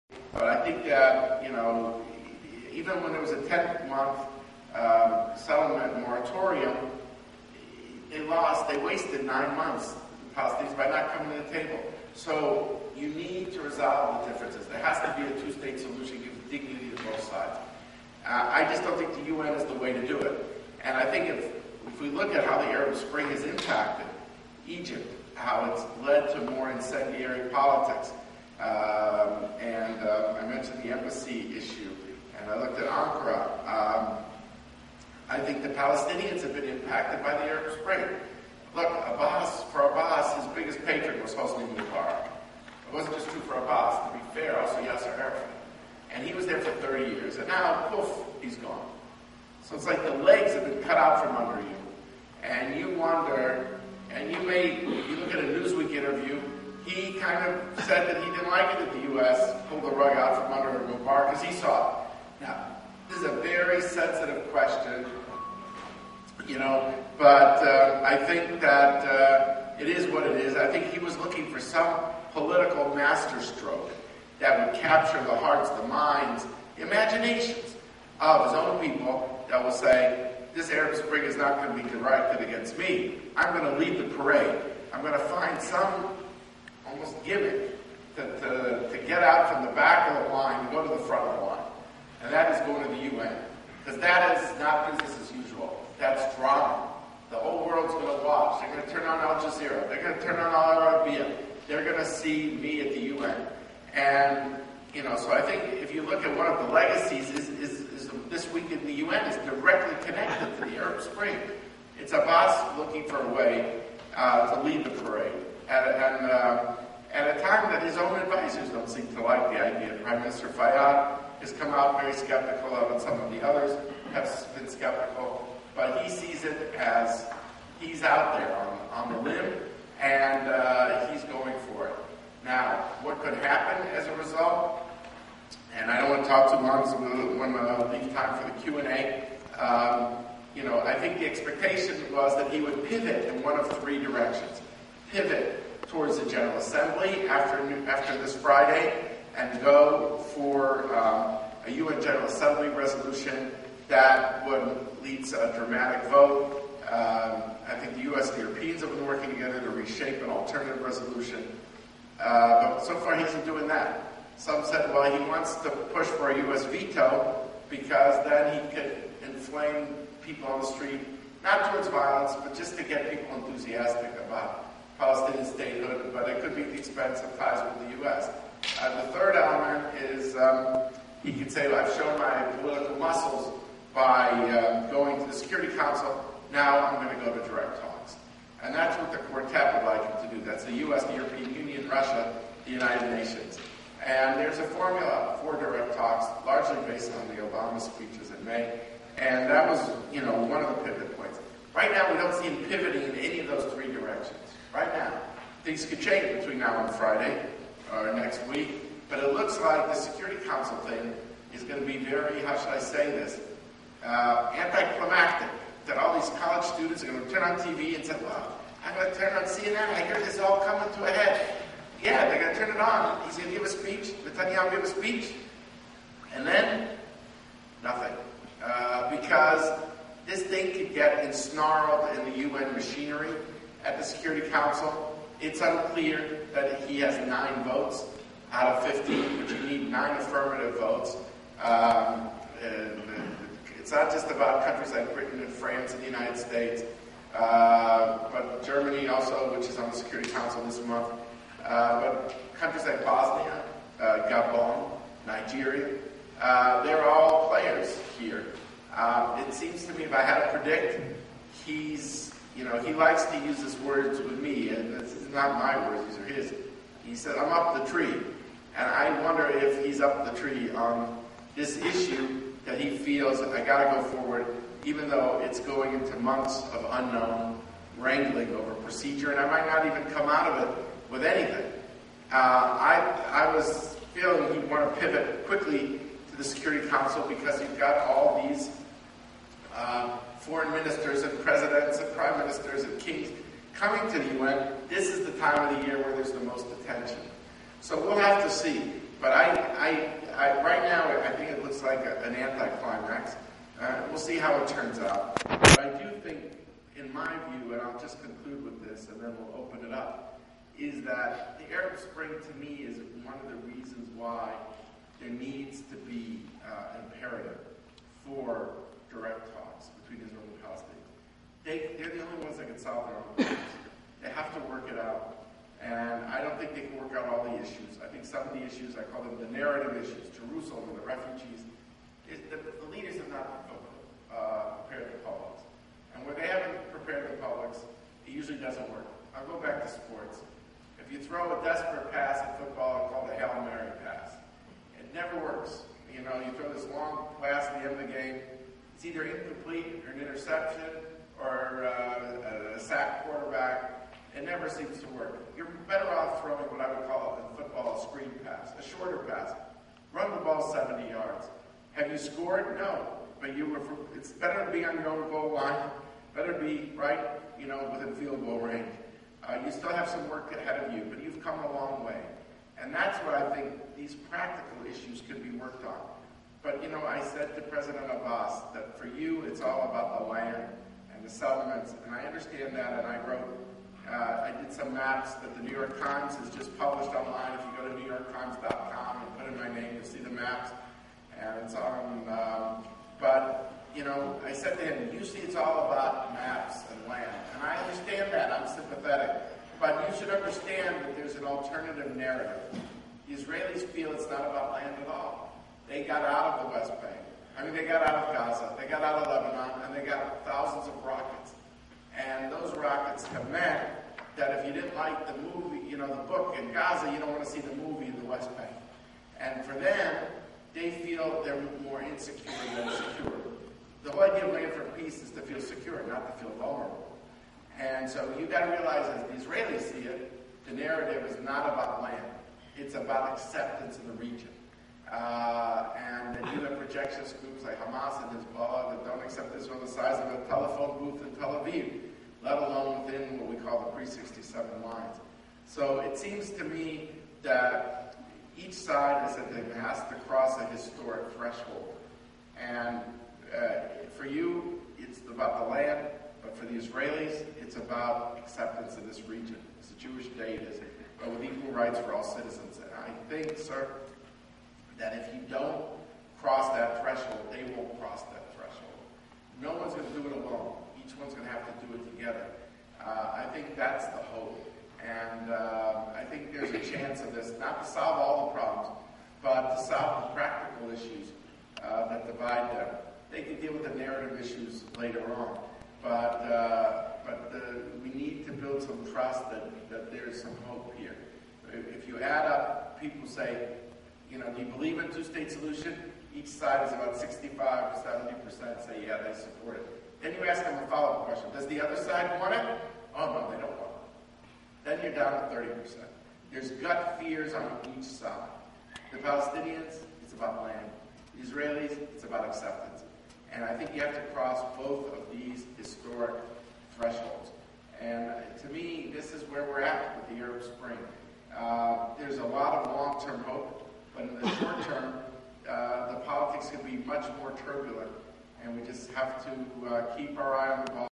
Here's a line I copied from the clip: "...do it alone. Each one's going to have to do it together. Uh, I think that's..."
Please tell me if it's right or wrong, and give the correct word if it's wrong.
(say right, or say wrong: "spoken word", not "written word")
right.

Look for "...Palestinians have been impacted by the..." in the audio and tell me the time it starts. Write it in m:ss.
0:35.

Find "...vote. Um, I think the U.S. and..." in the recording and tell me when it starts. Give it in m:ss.
2:36.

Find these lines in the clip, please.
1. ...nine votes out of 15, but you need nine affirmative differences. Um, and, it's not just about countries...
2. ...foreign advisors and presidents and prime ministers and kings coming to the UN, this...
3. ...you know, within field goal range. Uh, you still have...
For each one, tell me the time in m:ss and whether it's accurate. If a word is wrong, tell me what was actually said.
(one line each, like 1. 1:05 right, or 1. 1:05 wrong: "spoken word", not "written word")
1. 3:57 wrong: "votes", not "differences"
2. 4:50 wrong: "ministers", not "advisors"
3. 6:07 right.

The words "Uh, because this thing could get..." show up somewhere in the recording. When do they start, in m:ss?
3:48.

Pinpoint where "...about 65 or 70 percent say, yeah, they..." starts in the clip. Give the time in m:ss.
8:16.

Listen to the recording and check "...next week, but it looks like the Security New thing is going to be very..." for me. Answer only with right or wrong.
wrong.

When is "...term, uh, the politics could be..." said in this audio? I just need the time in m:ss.
8:44.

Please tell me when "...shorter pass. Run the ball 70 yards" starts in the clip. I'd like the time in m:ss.
5:58.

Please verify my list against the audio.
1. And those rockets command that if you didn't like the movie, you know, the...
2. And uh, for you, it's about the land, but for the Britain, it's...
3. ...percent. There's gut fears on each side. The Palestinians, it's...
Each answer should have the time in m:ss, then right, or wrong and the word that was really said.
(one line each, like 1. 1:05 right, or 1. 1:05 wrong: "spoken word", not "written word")
1. 6:52 right
2. 7:32 wrong: "Israelis", not "Britain"
3. 8:25 right.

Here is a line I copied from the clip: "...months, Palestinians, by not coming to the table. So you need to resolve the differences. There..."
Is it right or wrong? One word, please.
right.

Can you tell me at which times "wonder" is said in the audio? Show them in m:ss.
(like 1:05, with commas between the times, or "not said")
0:52, 4:29.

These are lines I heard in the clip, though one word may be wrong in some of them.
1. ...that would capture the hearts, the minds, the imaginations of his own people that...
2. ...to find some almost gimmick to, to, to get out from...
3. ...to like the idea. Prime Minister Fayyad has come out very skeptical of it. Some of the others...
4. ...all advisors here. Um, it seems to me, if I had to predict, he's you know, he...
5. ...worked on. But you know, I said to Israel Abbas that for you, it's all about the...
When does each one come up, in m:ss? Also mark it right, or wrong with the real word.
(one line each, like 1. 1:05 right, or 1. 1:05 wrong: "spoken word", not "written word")
1. 1:14 right
2. 1:25 right
3. 1:59 right
4. 4:17 wrong: "players", not "advisors"
5. 6:15 wrong: "President", not "Israel".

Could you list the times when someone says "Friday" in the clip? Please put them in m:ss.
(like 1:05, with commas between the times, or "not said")
2:28, 3:26.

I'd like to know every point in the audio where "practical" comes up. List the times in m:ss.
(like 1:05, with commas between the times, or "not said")
6:14, 8:00.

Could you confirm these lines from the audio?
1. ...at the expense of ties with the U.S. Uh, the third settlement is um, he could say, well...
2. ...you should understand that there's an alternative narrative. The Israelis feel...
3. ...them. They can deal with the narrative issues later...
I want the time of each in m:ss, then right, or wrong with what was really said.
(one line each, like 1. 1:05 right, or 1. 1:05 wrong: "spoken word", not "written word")
1. 2:56 wrong: "element", not "settlement"
2. 6:40 right
3. 8:02 right.